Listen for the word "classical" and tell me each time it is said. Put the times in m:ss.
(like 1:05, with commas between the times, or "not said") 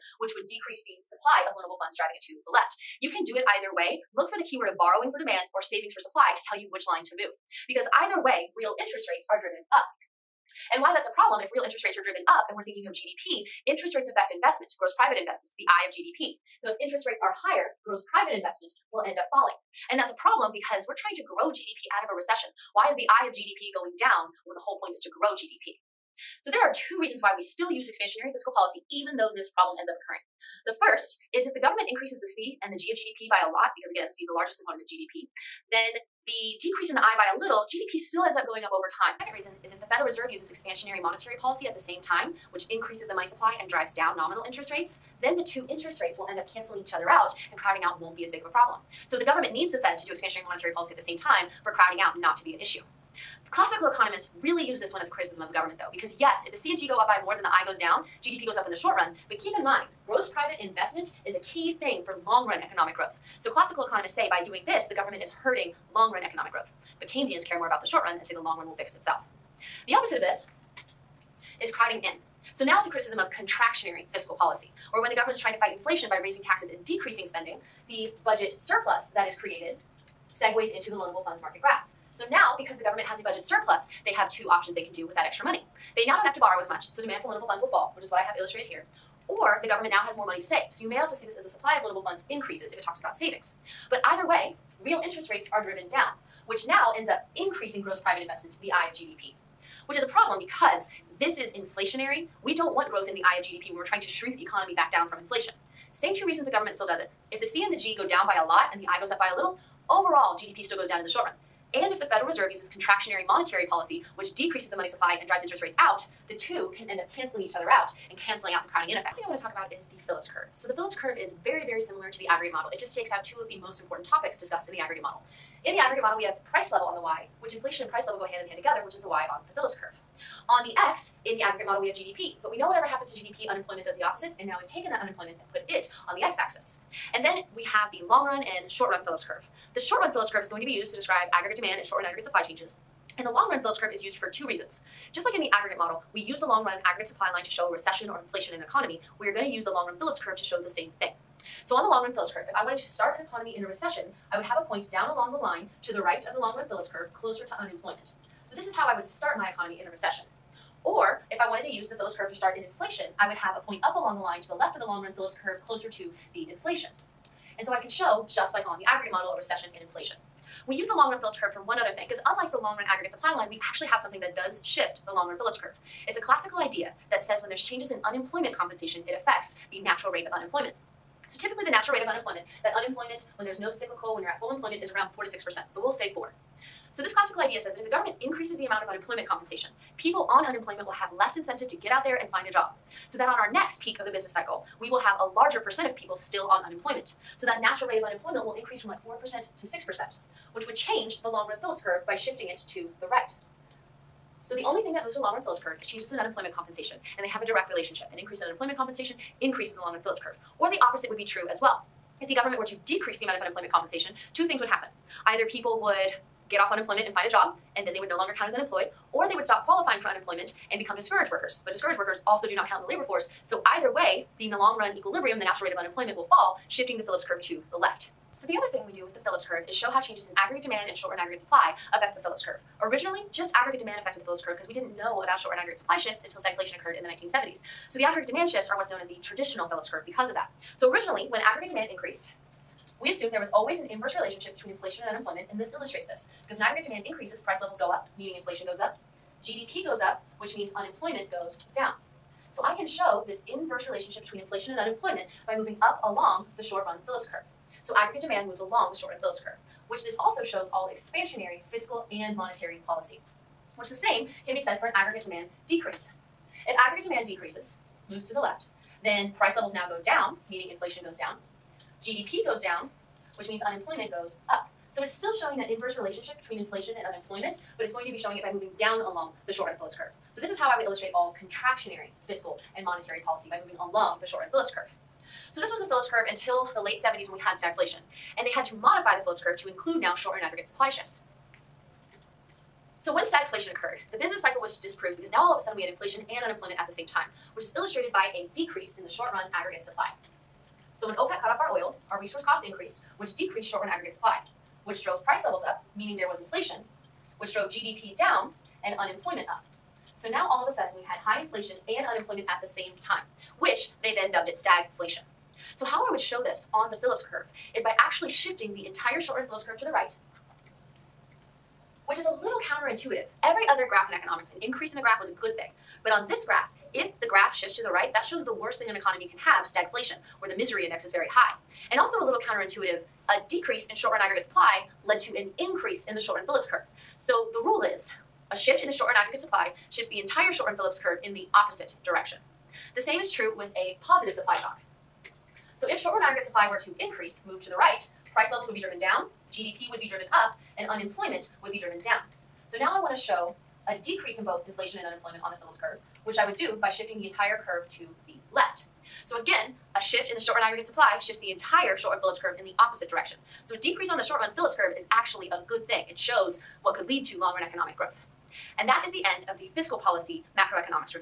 0:53, 1:03, 2:56, 3:07.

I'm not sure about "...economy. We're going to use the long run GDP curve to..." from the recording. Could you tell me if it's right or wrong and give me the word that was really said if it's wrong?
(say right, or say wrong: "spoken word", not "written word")
wrong: "Phillips", not "GDP".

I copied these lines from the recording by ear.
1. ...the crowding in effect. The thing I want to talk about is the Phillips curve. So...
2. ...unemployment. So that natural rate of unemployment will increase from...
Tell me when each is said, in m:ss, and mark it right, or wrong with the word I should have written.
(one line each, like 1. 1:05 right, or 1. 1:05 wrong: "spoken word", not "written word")
1. 1:58 right
2. 3:16 right.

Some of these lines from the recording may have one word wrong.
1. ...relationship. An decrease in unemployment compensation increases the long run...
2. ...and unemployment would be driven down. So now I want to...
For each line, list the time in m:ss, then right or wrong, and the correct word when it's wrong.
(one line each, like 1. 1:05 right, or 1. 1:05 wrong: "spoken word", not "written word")
1. 3:27 wrong: "increase", not "decrease"
2. 5:50 right.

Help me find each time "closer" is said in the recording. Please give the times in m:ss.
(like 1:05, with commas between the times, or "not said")
2:37, 2:45.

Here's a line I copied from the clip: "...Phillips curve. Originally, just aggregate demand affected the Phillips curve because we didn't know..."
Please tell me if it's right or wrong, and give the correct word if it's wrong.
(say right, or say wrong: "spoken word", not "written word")
right.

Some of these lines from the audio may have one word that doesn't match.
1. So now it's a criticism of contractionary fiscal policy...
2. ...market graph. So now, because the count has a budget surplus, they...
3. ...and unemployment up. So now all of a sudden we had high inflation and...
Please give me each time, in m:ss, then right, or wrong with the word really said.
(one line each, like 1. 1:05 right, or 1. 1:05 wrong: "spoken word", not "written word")
1. 1:12 right
2. 1:21 wrong: "government", not "count"
3. 5:08 right.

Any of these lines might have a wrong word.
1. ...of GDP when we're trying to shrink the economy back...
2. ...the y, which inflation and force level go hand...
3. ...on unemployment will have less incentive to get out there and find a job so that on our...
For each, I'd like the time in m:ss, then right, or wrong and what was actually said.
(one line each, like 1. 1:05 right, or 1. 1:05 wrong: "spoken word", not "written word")
1. 1:43 right
2. 2:06 wrong: "price", not "force"
3. 3:10 right.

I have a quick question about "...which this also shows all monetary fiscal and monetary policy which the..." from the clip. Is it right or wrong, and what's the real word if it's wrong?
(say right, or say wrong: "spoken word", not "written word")
wrong: "expansionary", not "monetary".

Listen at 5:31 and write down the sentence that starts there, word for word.
And also a little counterintuitive a decrease in short run aggregate supply led to an increase in the short run Phillips curve.